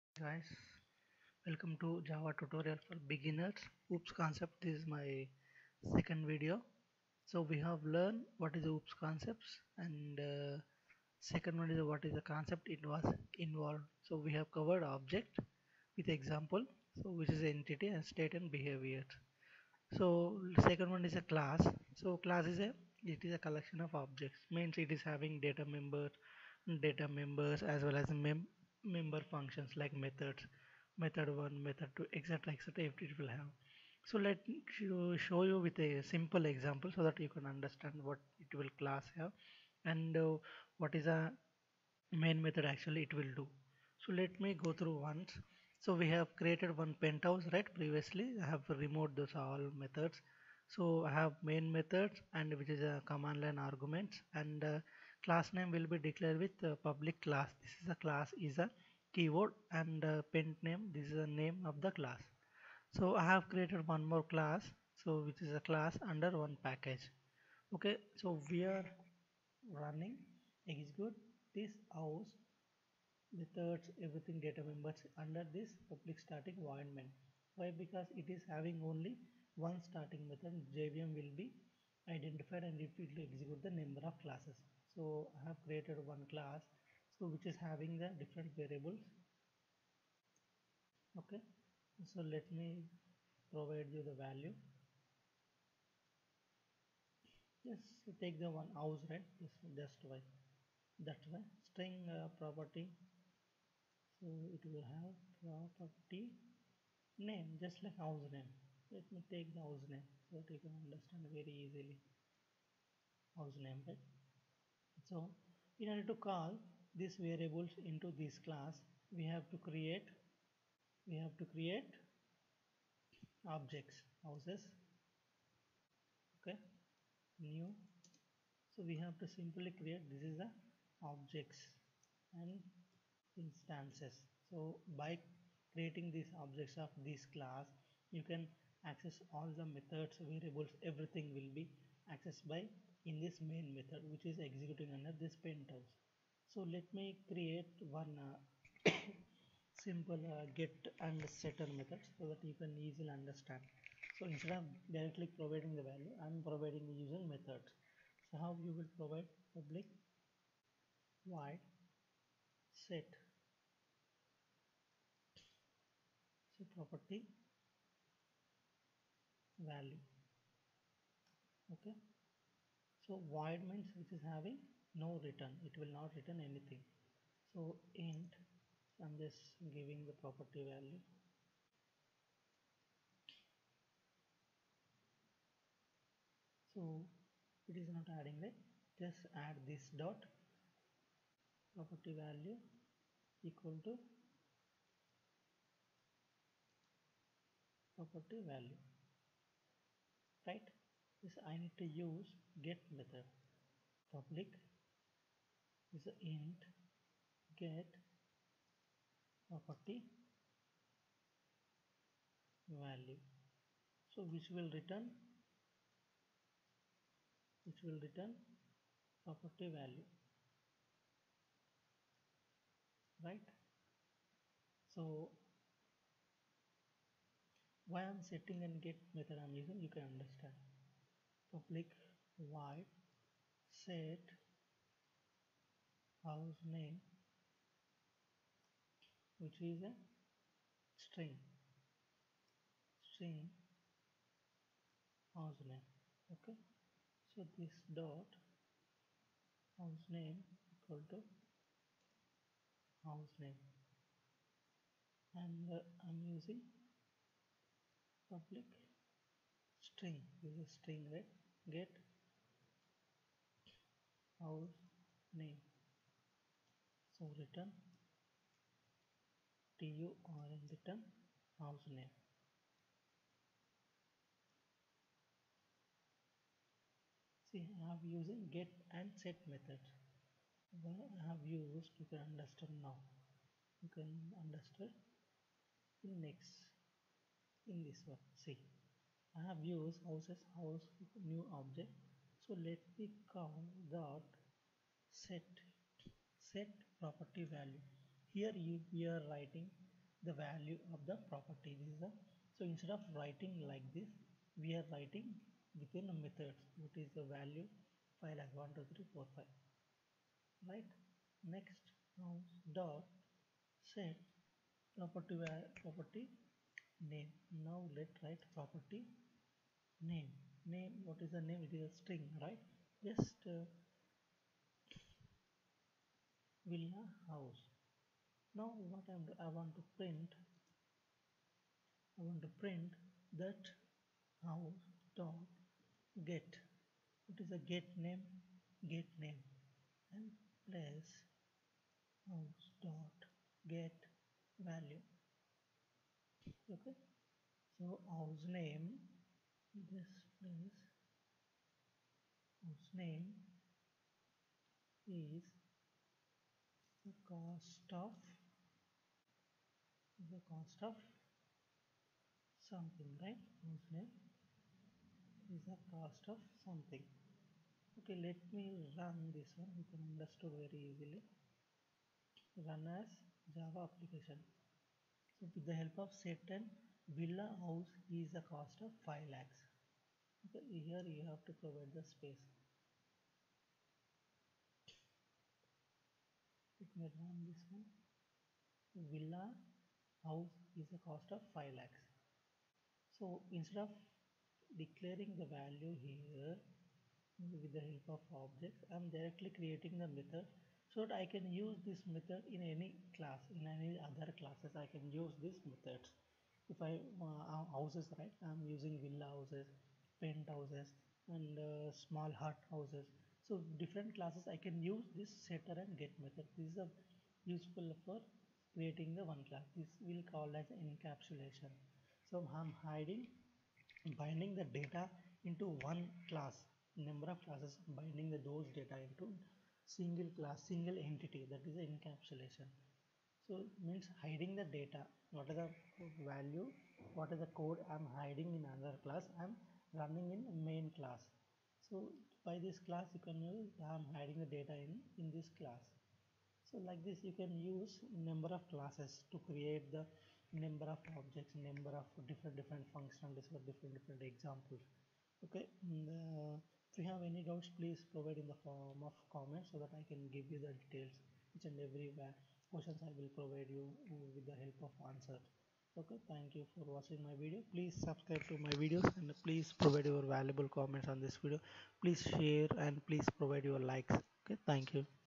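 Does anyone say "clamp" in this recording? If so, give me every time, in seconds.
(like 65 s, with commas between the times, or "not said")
not said.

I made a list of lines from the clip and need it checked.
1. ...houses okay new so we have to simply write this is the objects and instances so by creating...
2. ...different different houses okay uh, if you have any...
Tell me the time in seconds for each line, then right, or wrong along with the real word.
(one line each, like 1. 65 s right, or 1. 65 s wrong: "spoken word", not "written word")
1. 124 s wrong: "create", not "write"
2. 453 s wrong: "examples", not "houses".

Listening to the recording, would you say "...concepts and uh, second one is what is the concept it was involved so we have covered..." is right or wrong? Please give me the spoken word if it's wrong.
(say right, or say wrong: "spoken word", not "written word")
right.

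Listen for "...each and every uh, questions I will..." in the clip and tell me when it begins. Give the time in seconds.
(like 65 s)
461 s.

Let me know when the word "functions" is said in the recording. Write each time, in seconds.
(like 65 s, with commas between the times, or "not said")
29 s, 452 s.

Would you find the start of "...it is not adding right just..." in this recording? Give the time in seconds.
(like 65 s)
187 s.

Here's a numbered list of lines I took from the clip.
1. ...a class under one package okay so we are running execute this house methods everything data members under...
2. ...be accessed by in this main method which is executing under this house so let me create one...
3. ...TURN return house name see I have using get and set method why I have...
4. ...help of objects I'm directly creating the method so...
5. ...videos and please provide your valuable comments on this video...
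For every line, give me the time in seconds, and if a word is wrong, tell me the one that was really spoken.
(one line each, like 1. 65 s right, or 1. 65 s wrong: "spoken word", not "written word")
1. 65 s right
2. 141 s right
3. 269 s right
4. 397 s right
5. 468 s right.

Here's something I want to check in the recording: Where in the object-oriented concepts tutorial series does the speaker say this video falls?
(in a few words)
second video.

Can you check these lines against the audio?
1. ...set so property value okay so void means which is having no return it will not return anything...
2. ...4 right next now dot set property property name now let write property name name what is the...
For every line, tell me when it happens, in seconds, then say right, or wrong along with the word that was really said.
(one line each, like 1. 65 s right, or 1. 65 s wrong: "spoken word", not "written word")
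1. 162 s right
2. 309 s wrong: "5", not "4".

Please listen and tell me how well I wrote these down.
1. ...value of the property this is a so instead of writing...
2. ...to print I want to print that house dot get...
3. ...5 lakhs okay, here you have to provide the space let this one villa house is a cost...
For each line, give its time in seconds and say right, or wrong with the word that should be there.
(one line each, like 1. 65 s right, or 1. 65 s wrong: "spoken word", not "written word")
1. 300 s right
2. 329 s right
3. 379 s right.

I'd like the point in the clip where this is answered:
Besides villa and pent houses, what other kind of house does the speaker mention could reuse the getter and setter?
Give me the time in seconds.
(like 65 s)
412 s.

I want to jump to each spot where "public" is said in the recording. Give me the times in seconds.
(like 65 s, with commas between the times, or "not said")
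56 s, 75 s, 159 s, 204 s, 231 s, 258 s.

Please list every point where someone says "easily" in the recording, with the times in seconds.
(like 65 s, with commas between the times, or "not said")
111 s, 152 s, 370 s.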